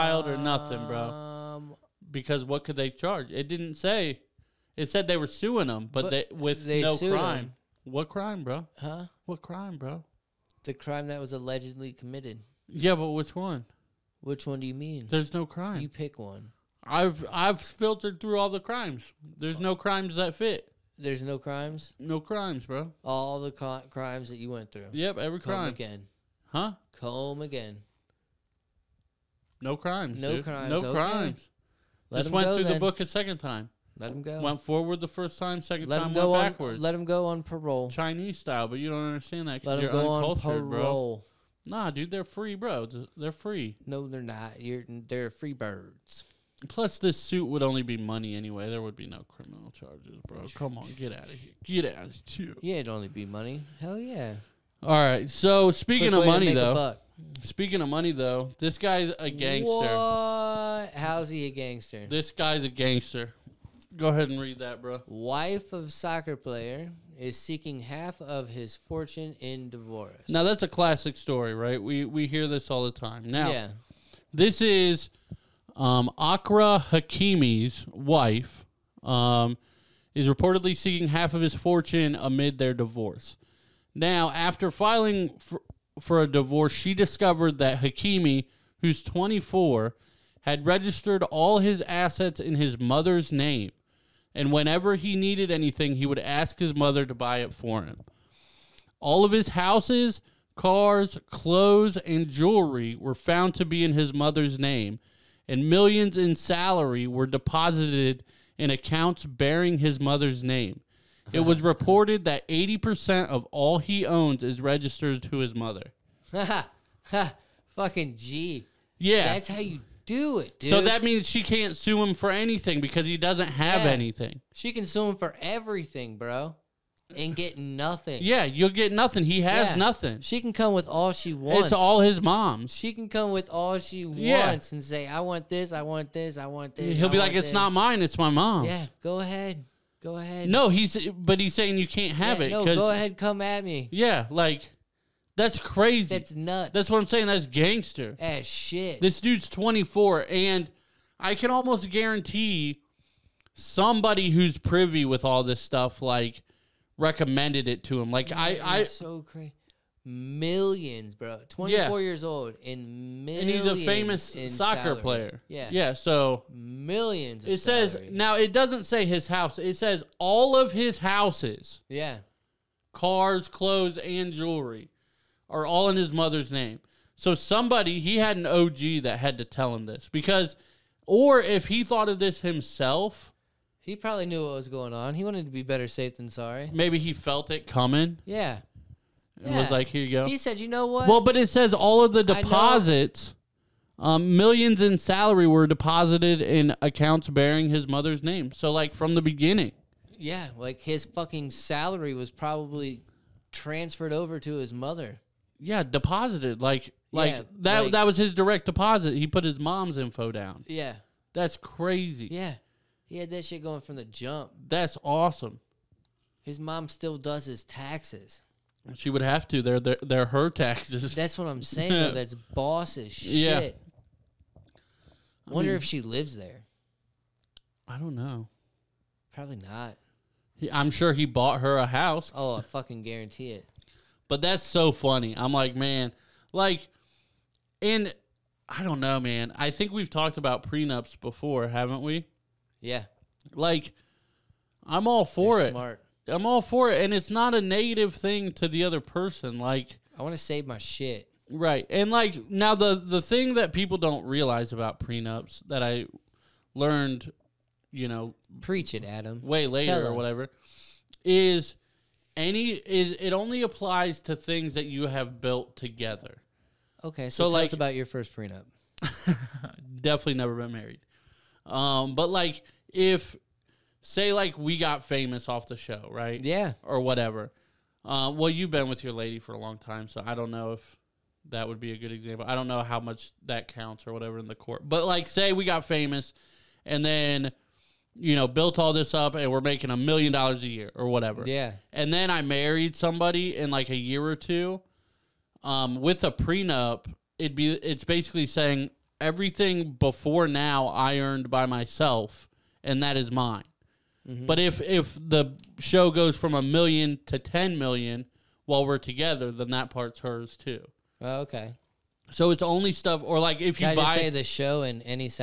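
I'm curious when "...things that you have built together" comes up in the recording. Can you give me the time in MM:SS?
04:24.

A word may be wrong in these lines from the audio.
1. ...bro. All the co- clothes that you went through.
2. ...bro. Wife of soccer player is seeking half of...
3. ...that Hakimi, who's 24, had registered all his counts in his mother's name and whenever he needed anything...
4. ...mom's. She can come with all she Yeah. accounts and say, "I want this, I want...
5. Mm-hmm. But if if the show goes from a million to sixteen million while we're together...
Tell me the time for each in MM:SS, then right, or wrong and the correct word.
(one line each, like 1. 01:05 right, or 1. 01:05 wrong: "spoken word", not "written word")
1. 00:22 wrong: "crimes", not "clothes"
2. 01:04 right
3. 01:27 wrong: "assets", not "counts"
4. 02:12 wrong: "wants", not "accounts"
5. 05:04 wrong: "ten", not "sixteen".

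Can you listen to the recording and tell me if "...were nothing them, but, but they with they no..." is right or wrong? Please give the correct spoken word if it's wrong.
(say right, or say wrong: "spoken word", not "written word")
wrong: "suing", not "nothing".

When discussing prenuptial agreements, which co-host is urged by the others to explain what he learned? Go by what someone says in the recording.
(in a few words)
Adam.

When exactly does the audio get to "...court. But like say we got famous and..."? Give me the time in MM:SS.
04:44.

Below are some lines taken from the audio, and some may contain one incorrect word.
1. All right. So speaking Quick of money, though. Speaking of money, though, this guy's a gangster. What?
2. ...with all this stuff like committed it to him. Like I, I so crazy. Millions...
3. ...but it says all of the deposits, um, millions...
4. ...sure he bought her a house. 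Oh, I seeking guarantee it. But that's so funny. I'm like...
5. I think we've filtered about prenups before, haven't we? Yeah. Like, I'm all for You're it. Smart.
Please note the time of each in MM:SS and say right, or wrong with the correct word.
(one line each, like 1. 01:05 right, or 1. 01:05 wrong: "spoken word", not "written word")
1. 00:54 right
2. 02:35 wrong: "recommended", not "committed"
3. 03:11 right
4. 03:50 wrong: "fucking", not "seeking"
5. 03:59 wrong: "talked", not "filtered".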